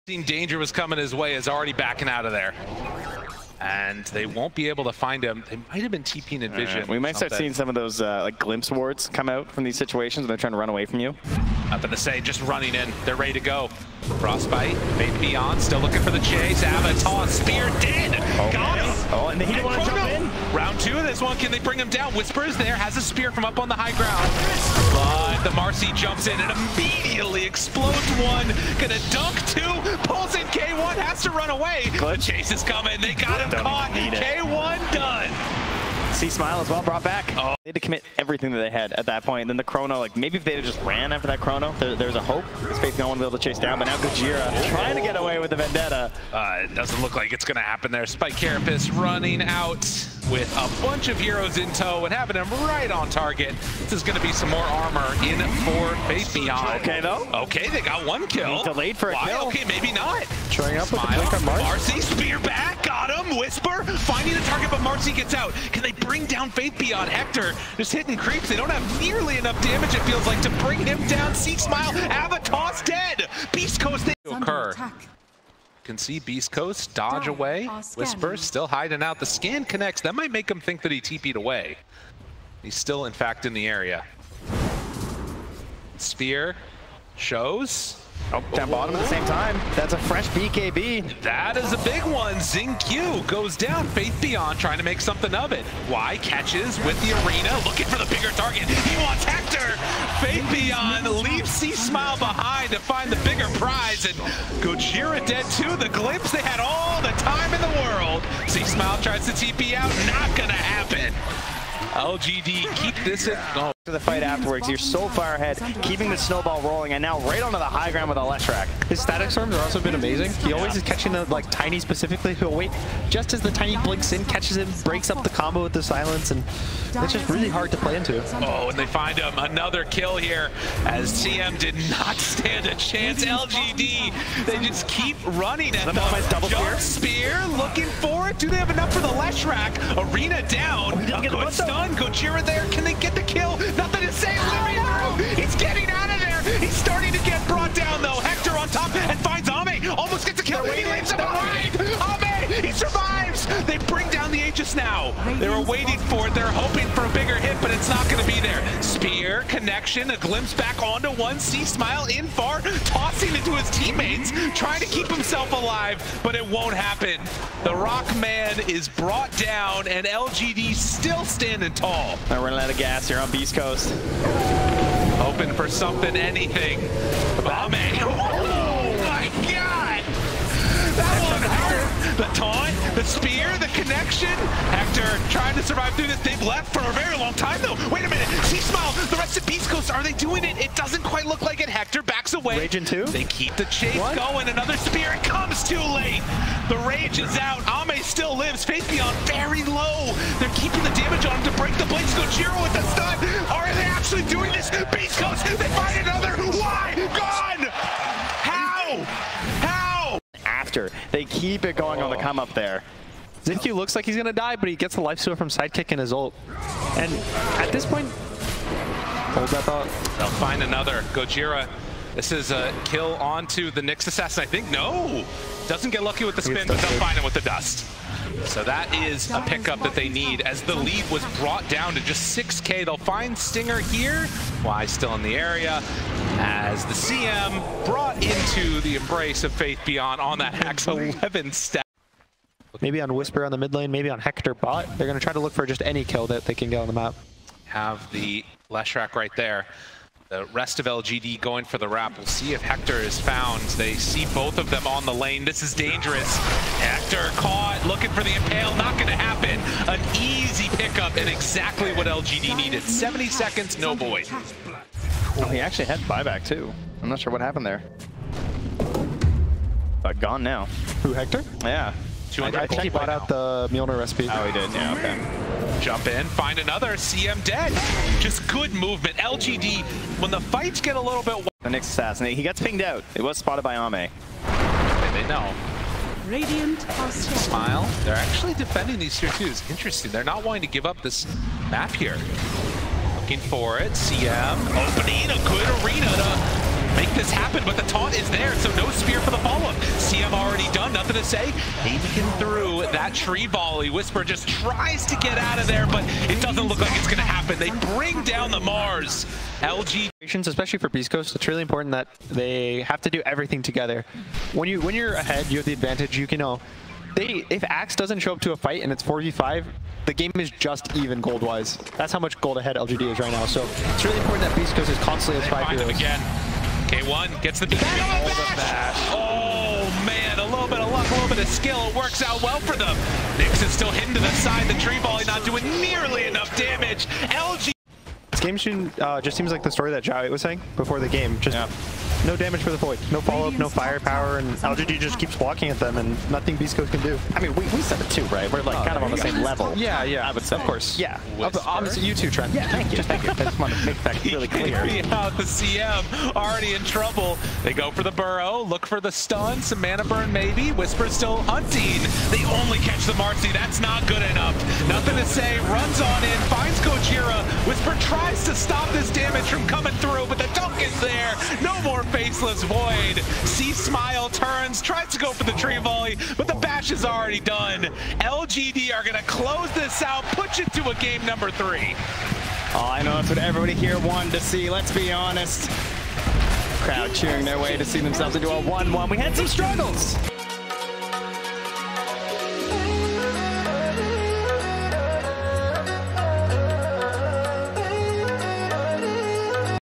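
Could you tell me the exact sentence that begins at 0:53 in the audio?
This is going to be some more armor in for Faith_bian.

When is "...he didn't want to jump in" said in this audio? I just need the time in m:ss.
0:19.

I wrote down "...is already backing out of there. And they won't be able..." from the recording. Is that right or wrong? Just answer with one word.
right.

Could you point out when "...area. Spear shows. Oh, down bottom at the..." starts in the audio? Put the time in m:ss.
1:23.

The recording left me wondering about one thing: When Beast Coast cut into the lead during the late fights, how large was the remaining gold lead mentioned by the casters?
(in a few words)
6k.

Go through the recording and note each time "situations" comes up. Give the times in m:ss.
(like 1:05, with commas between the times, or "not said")
0:09.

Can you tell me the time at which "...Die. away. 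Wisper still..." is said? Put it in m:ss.
1:17.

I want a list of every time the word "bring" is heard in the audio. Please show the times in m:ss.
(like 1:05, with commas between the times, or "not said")
0:21, 1:05, 1:10, 2:33, 5:07.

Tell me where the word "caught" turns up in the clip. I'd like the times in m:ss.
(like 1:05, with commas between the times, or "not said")
0:33, 4:17.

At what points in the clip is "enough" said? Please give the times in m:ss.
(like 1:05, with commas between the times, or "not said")
1:09, 2:18, 5:36, 6:04.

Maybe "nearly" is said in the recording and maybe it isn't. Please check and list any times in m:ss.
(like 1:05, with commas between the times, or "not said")
1:09, 5:35.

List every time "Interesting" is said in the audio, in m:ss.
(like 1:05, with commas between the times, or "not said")
4:49.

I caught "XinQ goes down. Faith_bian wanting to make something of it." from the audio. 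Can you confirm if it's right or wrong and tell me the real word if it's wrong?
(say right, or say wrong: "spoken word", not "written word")
wrong: "trying", not "wanting".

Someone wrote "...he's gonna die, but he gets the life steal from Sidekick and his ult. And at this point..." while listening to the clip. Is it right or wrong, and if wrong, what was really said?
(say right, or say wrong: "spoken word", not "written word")
right.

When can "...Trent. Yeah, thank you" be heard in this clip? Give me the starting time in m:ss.
5:52.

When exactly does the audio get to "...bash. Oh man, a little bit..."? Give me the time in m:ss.
5:28.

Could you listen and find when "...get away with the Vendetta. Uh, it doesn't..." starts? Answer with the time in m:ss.
0:45.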